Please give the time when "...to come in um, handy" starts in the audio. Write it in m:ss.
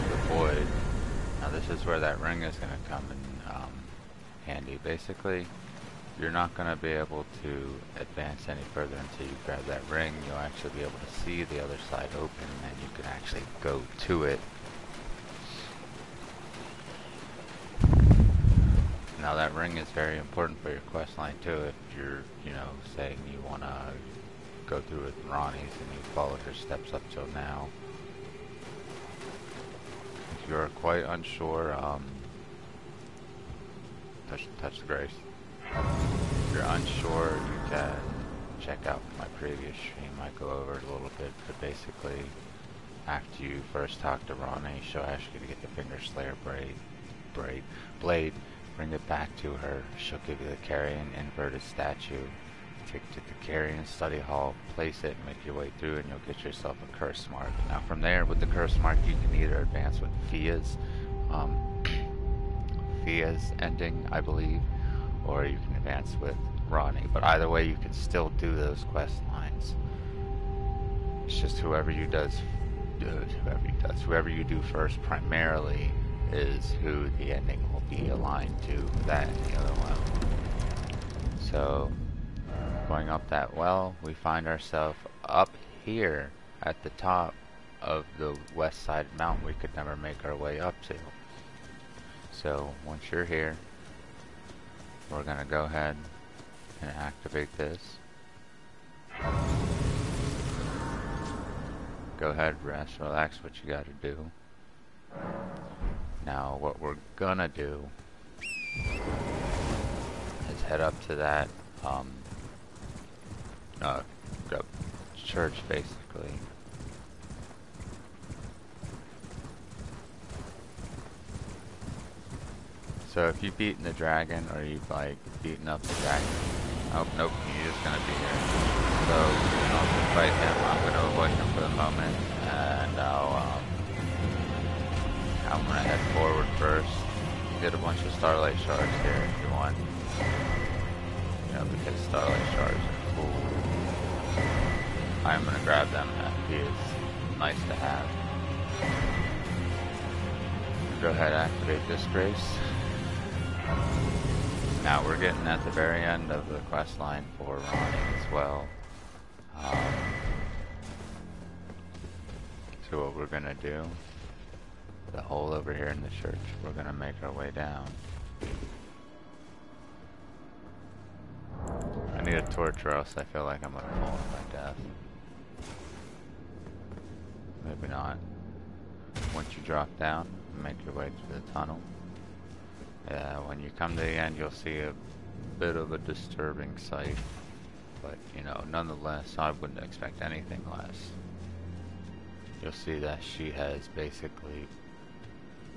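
0:02.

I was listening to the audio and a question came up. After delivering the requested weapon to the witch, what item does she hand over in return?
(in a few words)
Carrion inverted statue.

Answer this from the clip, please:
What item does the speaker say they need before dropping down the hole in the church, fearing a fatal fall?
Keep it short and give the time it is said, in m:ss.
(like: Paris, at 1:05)
A torch, at 2:52.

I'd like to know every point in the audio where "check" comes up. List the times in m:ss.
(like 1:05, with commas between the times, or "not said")
0:38.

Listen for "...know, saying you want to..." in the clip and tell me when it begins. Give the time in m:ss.
0:22.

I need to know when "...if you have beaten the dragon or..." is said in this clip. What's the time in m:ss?
2:03.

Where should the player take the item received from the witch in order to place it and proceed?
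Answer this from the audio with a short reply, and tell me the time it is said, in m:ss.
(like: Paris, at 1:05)
Carrion study hall, at 0:53.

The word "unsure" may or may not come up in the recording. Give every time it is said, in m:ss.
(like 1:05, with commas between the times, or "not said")
0:31, 0:36.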